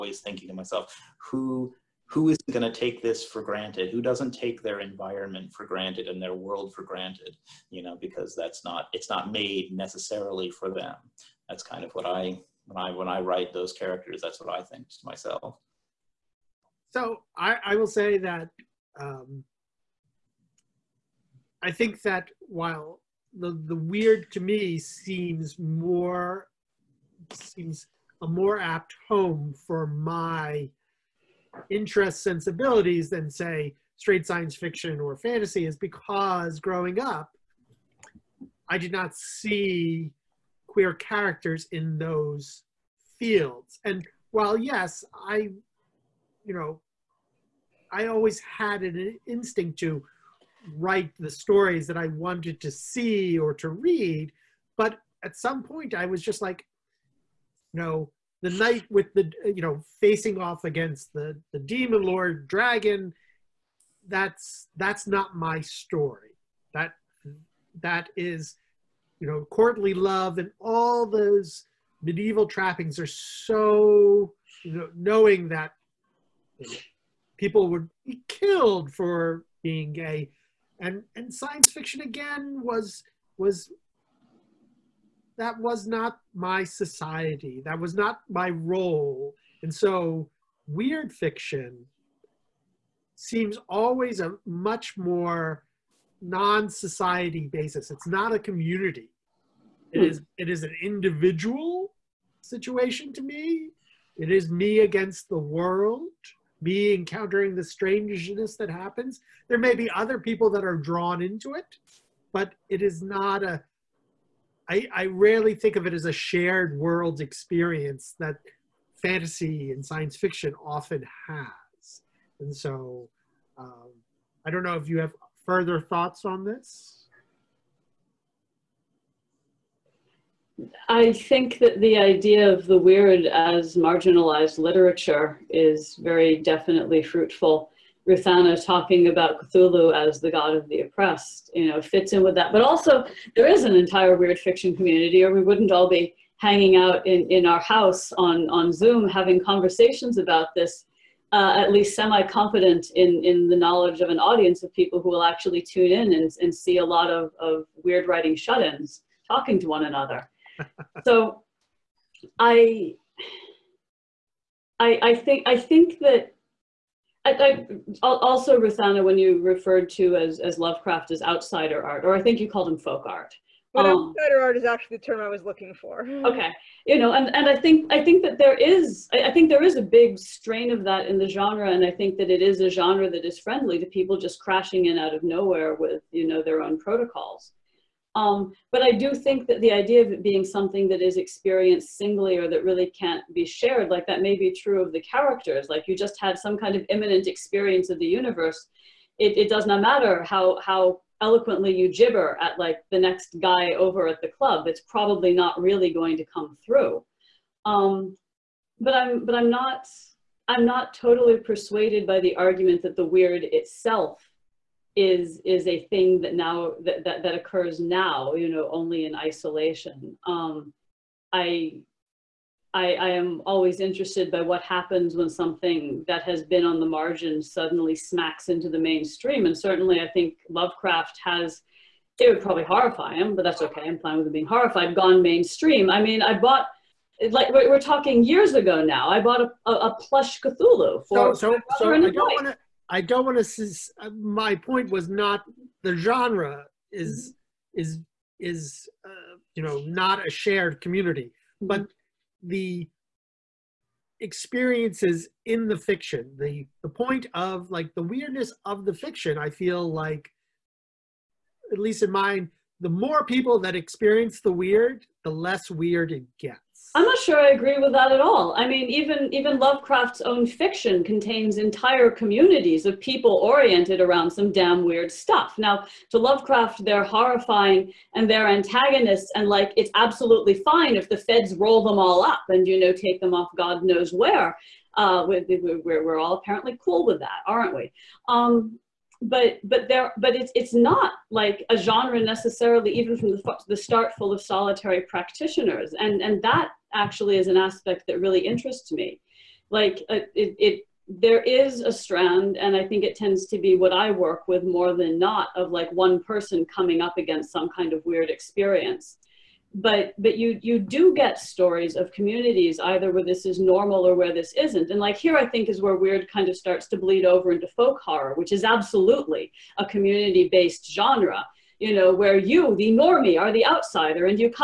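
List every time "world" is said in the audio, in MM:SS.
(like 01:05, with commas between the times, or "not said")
00:06, 01:45, 01:56.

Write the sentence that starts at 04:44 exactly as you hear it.
Uh, we're, we're, we're all apparently cool with that, aren't we?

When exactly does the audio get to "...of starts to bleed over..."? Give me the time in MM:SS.
05:16.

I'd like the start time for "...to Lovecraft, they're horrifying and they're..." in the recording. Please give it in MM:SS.
04:36.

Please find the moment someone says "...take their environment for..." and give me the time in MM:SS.
00:04.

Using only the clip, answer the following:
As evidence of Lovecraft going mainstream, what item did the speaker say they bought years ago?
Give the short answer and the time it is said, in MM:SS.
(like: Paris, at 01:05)
a plush Cthulhu, at 03:59.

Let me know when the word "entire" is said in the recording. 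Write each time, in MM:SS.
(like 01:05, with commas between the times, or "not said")
02:23, 04:31.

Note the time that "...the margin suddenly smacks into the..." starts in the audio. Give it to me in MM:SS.
03:46.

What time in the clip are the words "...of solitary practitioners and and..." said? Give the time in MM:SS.
04:54.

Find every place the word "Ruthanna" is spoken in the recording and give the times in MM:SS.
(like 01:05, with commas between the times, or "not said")
02:18, 02:48.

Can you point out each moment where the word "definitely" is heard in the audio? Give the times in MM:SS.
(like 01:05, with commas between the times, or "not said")
02:16.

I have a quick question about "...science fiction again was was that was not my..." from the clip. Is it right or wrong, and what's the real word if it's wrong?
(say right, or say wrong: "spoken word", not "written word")
right.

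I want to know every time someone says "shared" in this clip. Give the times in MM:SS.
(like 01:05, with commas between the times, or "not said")
01:56, 03:13, 04:10.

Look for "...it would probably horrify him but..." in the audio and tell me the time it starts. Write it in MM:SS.
03:52.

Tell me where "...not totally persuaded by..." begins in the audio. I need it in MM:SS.
03:30.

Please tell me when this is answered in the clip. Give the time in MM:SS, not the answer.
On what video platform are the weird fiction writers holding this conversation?
02:28.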